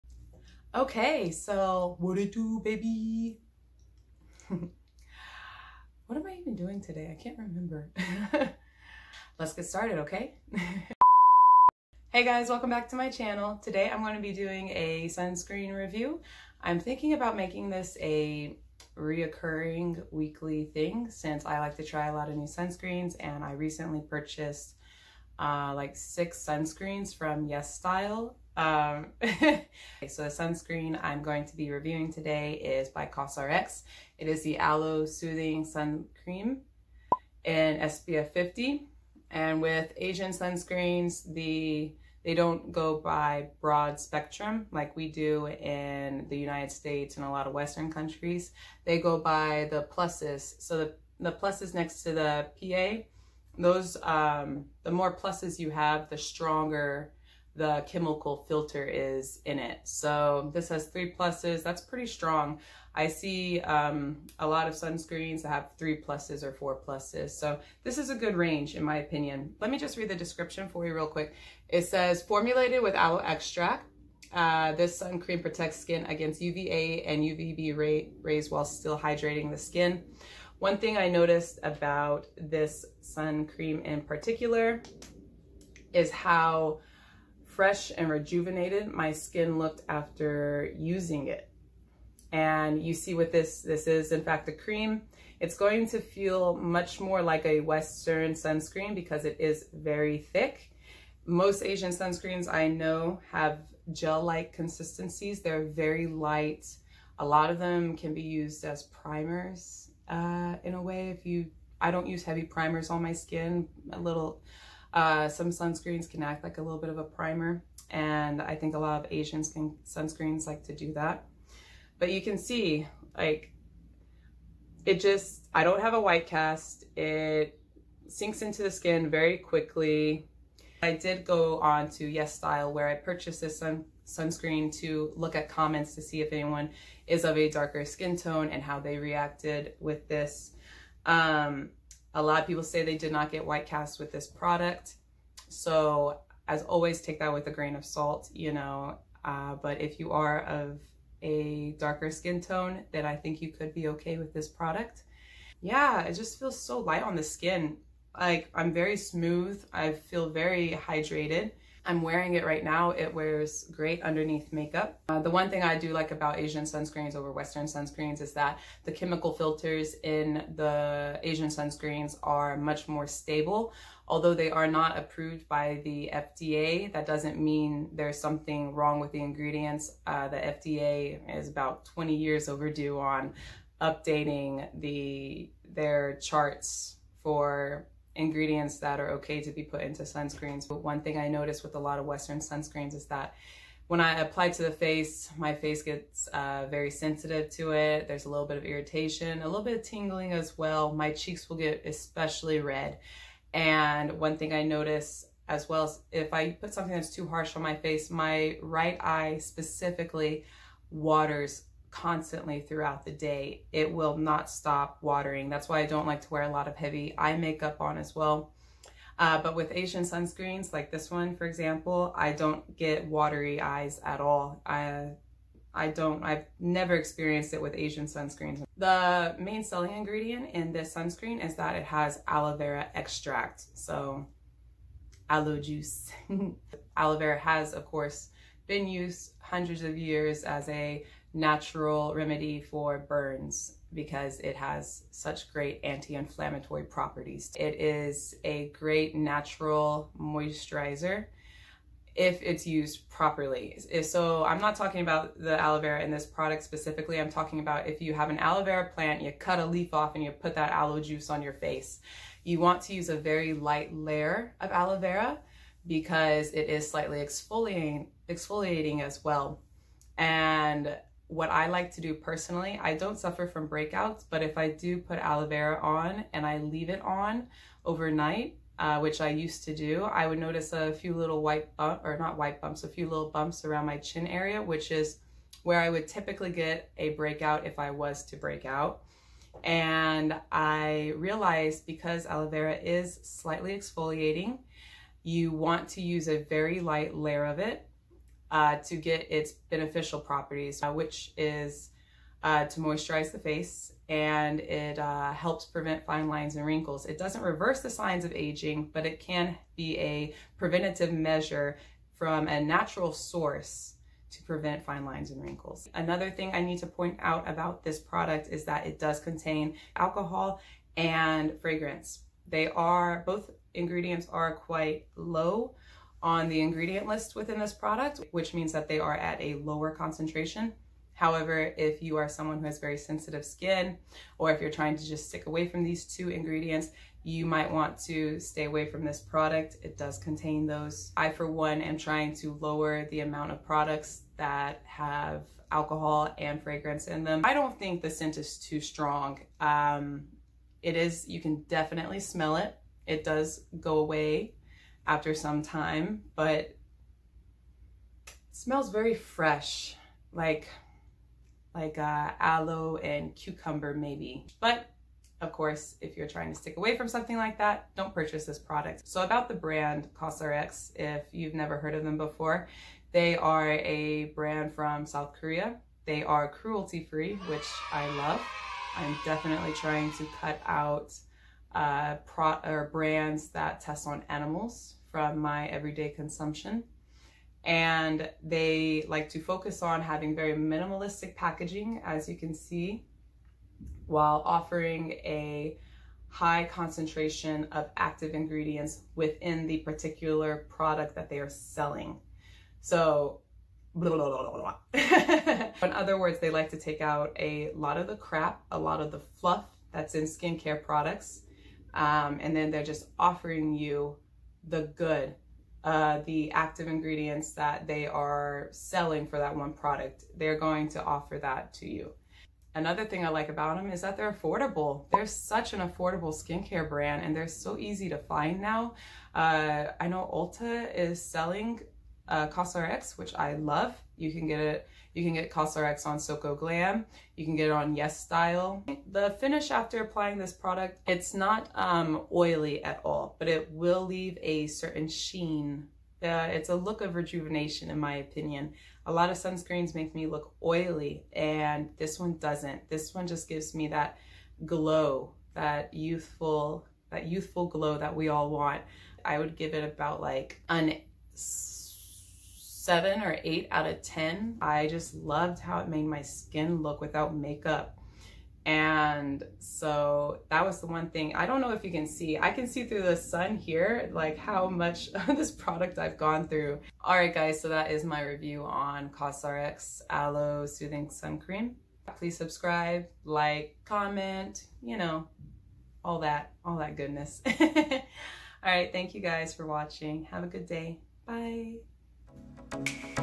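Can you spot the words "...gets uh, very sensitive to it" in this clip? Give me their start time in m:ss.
3:15.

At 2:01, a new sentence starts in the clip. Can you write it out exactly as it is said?
But you can see, like, it just, I don't have a white cast.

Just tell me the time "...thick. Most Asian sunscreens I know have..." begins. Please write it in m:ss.
1:40.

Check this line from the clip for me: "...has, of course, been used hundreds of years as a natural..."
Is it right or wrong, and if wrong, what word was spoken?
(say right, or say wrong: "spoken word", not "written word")
right.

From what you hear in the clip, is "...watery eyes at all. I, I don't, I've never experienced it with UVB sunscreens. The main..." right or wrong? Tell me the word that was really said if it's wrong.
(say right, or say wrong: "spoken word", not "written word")
wrong: "Asian", not "UVB".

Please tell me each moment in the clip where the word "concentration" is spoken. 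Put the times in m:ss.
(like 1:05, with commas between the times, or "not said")
5:29, 6:36.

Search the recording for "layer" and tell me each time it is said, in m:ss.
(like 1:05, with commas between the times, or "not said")
4:23, 4:57.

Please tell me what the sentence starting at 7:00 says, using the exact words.
They're going to offer that to you.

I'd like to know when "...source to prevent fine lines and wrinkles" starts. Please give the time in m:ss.
5:13.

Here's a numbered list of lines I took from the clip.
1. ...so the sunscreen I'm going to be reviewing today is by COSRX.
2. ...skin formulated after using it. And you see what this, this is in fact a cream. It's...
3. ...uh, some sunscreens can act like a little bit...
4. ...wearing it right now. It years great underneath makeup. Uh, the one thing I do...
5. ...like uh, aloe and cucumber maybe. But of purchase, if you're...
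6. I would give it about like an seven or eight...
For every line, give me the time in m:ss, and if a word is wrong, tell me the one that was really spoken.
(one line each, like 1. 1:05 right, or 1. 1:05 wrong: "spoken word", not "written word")
1. 0:30 right
2. 1:29 wrong: "looked", not "formulated"
3. 1:54 right
4. 2:42 wrong: "wears", not "years"
5. 6:01 wrong: "course", not "purchase"
6. 7:39 right.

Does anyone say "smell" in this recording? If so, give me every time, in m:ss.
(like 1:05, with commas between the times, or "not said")
5:52, 5:58.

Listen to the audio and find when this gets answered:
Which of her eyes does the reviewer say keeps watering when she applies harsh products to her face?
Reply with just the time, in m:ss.
3:28.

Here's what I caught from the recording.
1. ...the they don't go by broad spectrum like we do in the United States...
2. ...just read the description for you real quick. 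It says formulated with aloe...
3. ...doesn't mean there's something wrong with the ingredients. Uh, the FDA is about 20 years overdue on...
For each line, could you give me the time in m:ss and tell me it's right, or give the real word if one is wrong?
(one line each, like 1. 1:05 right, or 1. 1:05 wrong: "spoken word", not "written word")
1. 0:41 right
2. 1:09 right
3. 2:57 right.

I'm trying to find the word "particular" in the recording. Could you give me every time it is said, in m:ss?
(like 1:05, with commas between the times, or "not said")
1:24, 6:39.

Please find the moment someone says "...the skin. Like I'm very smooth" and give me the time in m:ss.
2:37.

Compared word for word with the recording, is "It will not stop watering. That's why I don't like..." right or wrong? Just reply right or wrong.
right.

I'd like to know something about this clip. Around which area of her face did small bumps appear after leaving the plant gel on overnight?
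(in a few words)
Chin.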